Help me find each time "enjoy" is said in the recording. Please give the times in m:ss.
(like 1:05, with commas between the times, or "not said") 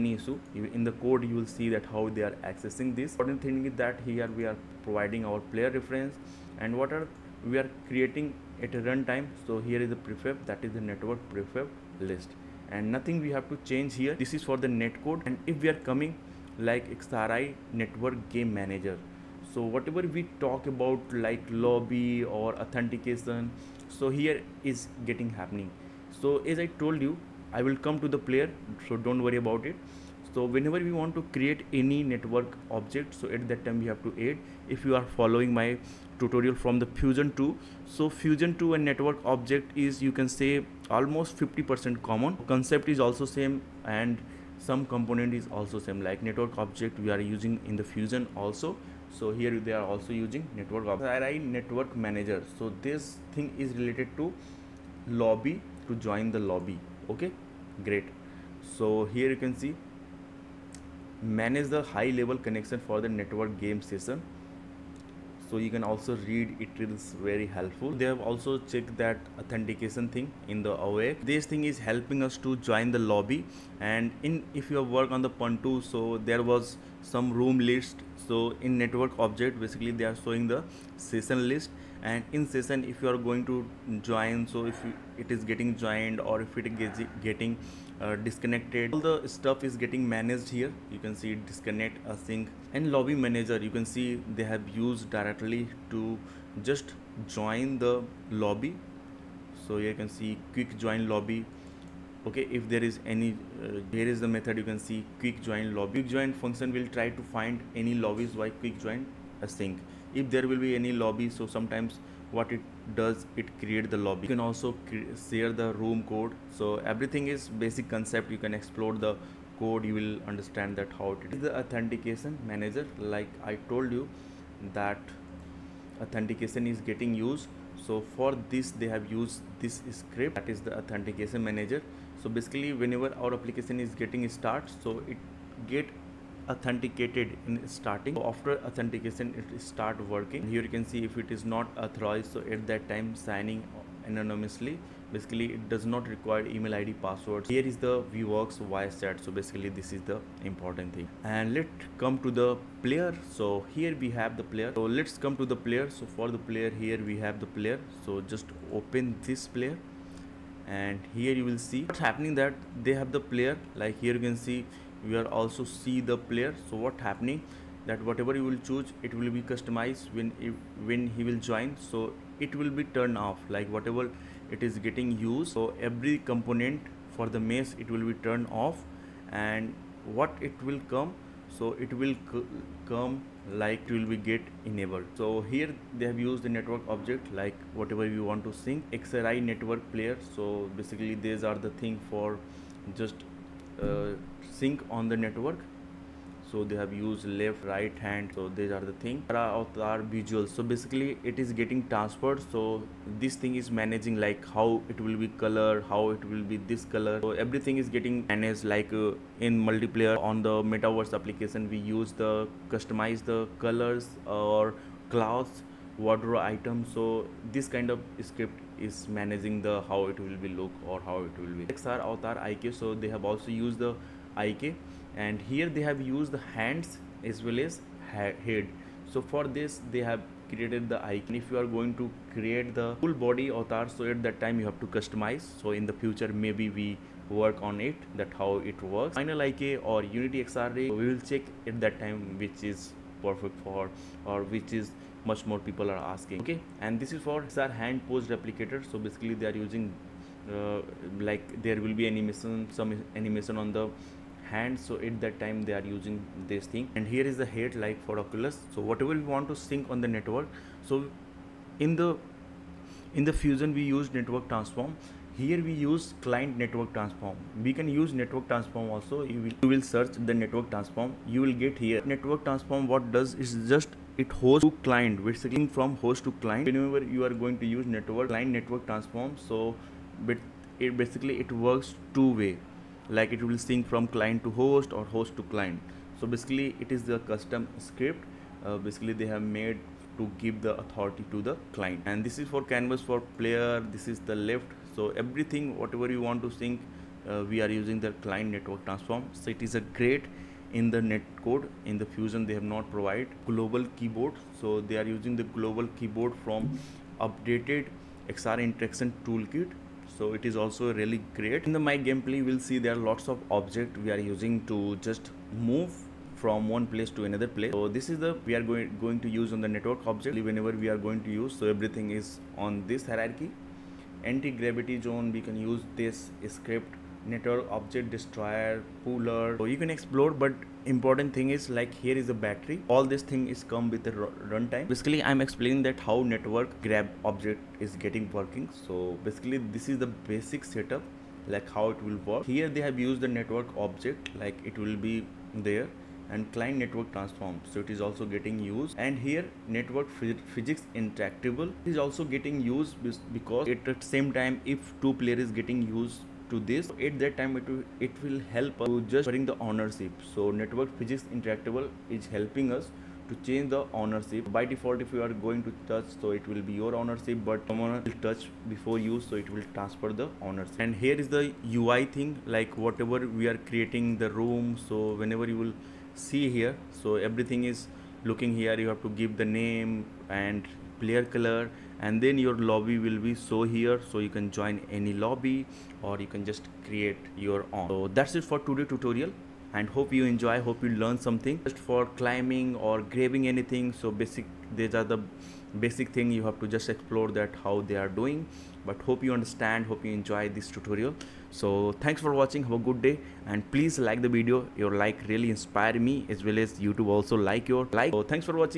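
6:30, 6:40.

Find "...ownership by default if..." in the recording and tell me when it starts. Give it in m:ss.
6:03.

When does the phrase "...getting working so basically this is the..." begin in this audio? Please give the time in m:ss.
5:38.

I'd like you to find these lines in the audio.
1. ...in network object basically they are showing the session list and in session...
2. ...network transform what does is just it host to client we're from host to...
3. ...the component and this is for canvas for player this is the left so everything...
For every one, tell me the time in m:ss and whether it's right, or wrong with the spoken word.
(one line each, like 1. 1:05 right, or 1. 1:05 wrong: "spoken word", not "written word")
1. 1:18 right
2. 4:32 right
3. 4:51 wrong: "client", not "component".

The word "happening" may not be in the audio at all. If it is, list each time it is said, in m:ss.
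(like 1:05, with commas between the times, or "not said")
0:25, 2:41, 2:46.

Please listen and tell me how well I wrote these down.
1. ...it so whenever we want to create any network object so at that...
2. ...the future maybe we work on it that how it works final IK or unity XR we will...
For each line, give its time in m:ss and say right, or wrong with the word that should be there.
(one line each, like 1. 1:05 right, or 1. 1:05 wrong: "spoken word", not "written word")
1. 0:29 right
2. 3:55 right.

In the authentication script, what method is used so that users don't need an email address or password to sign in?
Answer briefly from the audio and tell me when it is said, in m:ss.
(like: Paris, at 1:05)
signing anonymously, at 2:23.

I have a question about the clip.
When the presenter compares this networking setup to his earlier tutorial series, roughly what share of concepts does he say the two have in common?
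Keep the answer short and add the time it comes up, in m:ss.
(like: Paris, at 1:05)
50%, at 0:41.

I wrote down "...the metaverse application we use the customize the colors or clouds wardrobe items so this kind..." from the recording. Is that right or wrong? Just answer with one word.
right.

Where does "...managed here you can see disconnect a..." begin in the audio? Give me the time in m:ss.
1:30.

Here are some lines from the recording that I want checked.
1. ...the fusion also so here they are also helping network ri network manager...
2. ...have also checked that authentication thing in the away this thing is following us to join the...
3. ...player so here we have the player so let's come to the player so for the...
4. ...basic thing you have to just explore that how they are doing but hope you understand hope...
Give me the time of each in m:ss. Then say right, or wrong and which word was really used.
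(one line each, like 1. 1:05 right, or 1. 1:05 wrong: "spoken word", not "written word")
1. 0:47 wrong: "using", not "helping"
2. 1:08 wrong: "helping", not "following"
3. 2:32 right
4. 6:35 right.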